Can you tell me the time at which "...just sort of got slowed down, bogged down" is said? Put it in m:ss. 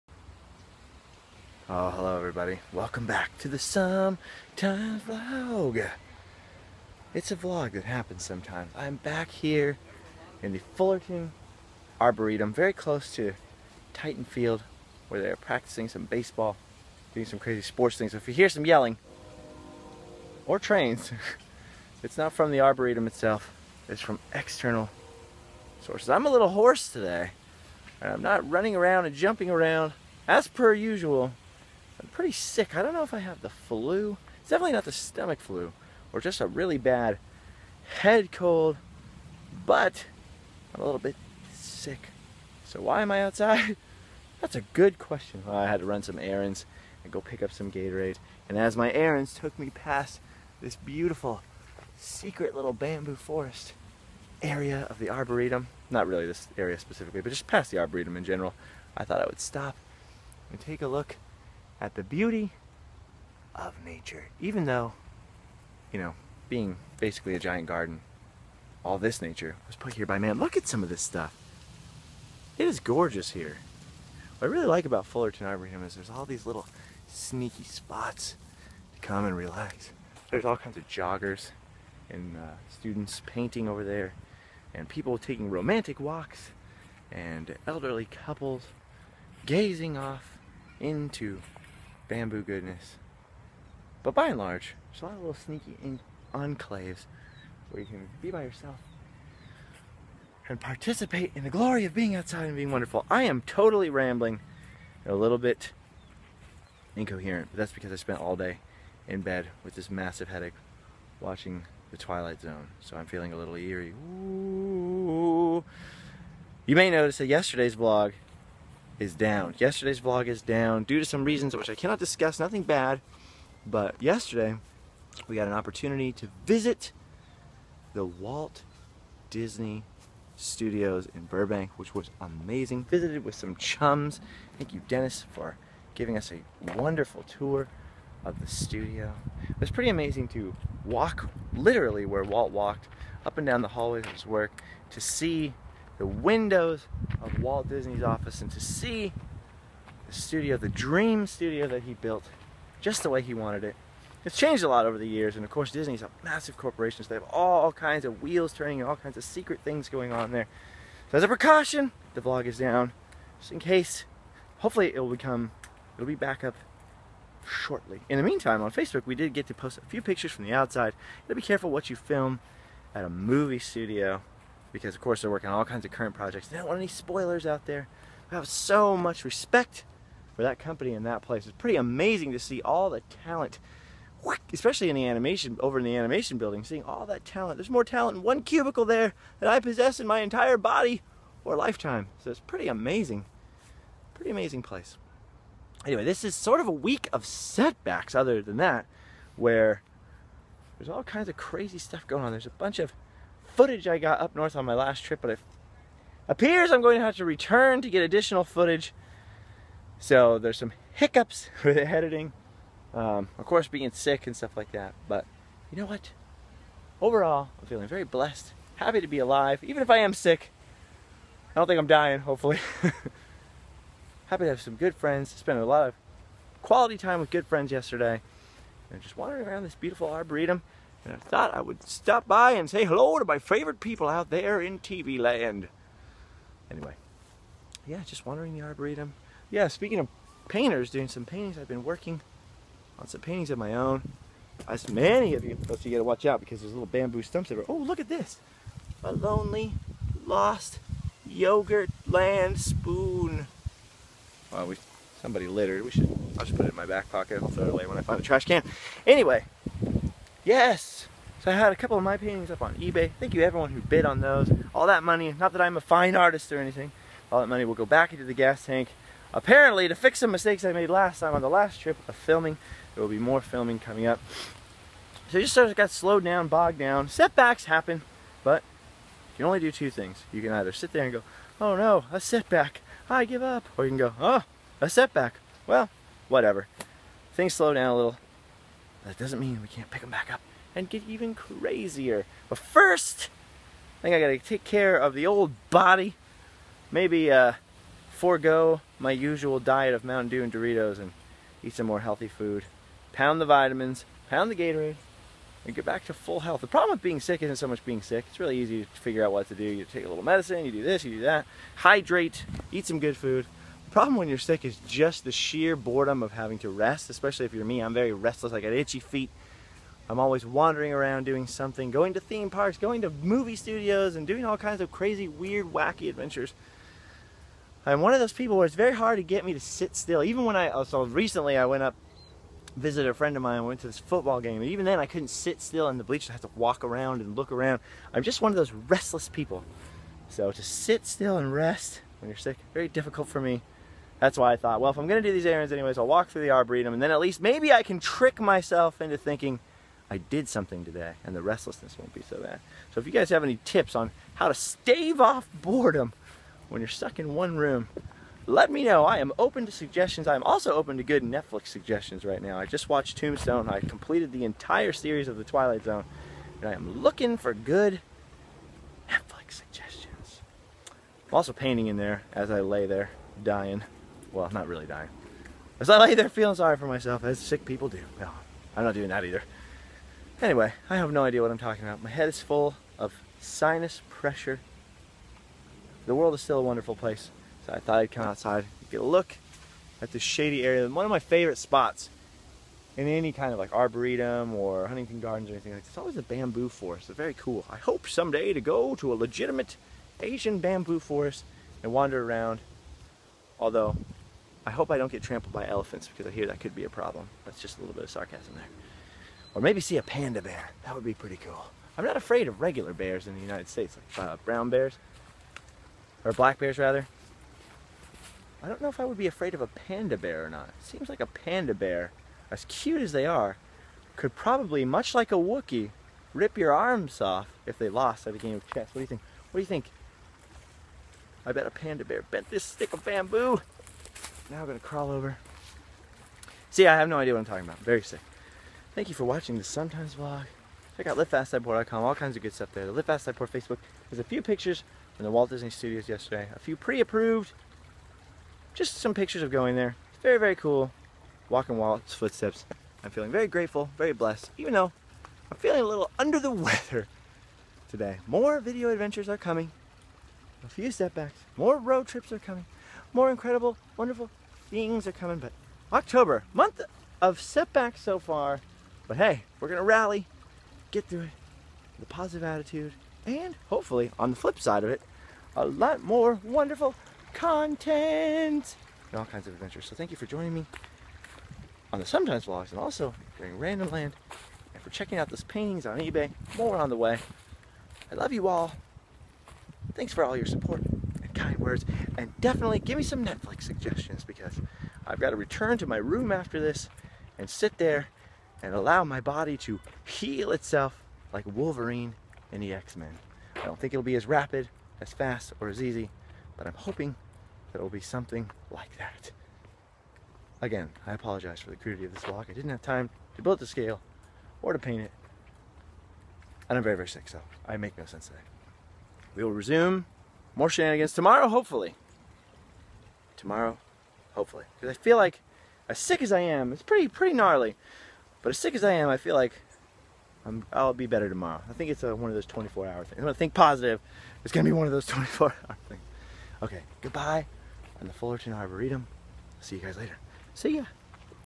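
4:35.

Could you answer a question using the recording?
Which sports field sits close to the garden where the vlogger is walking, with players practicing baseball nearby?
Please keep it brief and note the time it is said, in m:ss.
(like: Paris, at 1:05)
Titan Field, at 0:13.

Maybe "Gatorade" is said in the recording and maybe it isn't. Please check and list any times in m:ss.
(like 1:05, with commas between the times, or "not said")
0:47, 5:04.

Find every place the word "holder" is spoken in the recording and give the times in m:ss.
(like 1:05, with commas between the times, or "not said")
not said.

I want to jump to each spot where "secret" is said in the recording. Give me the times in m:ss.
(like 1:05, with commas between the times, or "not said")
0:51, 2:39.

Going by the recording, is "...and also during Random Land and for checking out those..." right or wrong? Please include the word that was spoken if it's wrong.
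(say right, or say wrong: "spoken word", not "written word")
right.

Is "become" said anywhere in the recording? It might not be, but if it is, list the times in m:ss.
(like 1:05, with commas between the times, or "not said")
2:45.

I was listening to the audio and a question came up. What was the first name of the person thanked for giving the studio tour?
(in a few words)
Dennis.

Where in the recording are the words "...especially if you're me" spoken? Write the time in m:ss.
5:17.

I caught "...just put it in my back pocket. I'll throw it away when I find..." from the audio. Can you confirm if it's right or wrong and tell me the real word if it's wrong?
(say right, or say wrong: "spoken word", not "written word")
right.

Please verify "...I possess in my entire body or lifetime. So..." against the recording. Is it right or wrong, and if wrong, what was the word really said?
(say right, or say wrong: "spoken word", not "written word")
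right.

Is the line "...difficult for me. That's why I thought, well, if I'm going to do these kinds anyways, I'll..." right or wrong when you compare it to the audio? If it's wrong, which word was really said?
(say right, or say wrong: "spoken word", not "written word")
wrong: "errands", not "kinds".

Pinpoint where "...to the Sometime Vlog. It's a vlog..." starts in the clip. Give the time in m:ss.
0:03.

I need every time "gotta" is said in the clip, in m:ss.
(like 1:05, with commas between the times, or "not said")
2:51, 4:05, 4:54.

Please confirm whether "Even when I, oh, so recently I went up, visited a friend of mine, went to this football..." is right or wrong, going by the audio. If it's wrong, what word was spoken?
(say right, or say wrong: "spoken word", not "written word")
right.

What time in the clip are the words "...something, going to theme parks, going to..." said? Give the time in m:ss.
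5:21.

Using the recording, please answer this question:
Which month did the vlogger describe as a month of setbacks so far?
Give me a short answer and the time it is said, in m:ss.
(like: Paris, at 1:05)
October, at 7:45.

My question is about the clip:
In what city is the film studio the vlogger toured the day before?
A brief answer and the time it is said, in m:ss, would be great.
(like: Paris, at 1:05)
Burbank, at 2:11.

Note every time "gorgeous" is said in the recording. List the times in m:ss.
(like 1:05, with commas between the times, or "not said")
1:12.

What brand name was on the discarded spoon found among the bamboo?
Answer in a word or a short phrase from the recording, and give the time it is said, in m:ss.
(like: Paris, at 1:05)
Yogurt Land, at 4:11.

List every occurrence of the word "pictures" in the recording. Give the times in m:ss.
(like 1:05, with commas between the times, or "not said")
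2:50, 7:24, 7:29.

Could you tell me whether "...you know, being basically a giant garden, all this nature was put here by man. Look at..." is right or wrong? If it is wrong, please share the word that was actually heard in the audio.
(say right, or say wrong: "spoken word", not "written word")
right.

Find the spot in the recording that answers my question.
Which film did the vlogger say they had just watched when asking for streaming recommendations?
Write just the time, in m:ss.
6:03.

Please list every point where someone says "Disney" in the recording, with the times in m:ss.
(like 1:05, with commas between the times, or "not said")
2:09, 2:27, 2:35, 7:25.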